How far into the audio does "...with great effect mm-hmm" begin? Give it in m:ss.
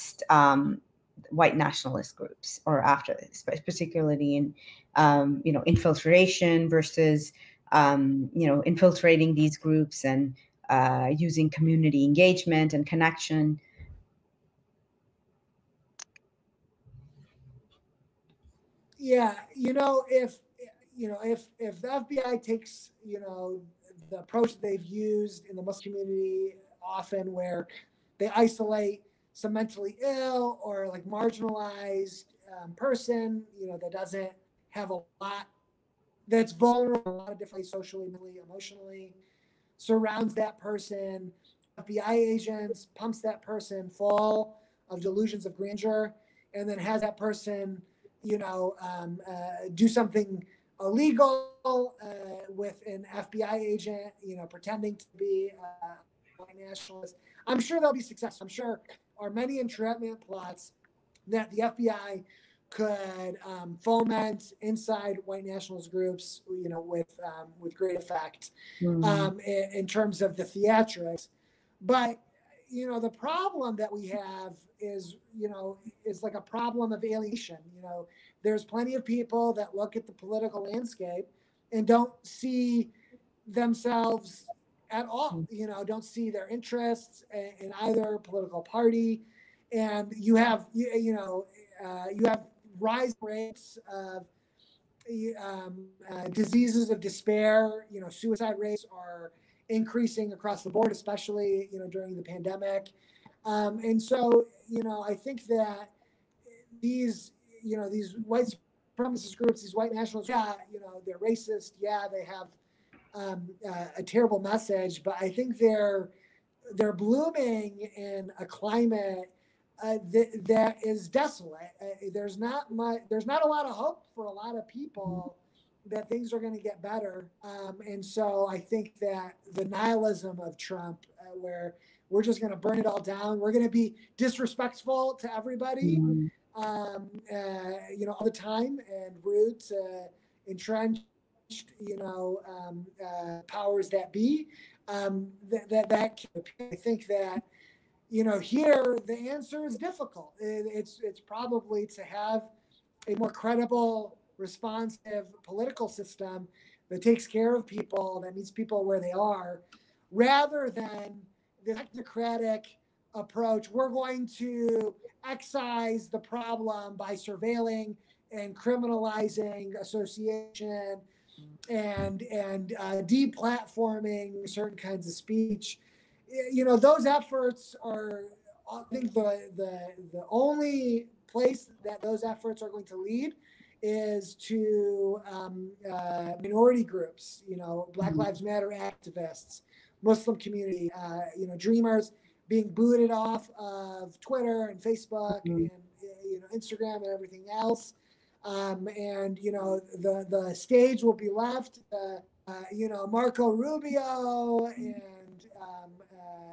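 1:07.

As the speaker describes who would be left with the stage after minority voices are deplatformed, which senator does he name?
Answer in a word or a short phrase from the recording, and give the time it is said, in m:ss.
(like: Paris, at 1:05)
Marco Rubio, at 3:23.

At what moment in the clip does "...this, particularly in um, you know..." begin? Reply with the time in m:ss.
0:03.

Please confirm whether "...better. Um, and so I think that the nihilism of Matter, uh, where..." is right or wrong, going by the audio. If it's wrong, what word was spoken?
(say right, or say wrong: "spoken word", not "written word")
wrong: "Trump", not "Matter".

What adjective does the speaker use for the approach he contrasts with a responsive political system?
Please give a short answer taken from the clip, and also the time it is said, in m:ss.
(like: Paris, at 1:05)
Technocratic, at 2:41.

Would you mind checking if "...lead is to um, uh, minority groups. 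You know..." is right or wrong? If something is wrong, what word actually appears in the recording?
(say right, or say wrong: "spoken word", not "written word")
right.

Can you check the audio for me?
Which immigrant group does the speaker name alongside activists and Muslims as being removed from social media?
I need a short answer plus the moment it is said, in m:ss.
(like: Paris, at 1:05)
Dreamers, at 3:11.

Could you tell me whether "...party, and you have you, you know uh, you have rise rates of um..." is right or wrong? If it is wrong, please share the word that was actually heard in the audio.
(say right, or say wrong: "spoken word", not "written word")
right.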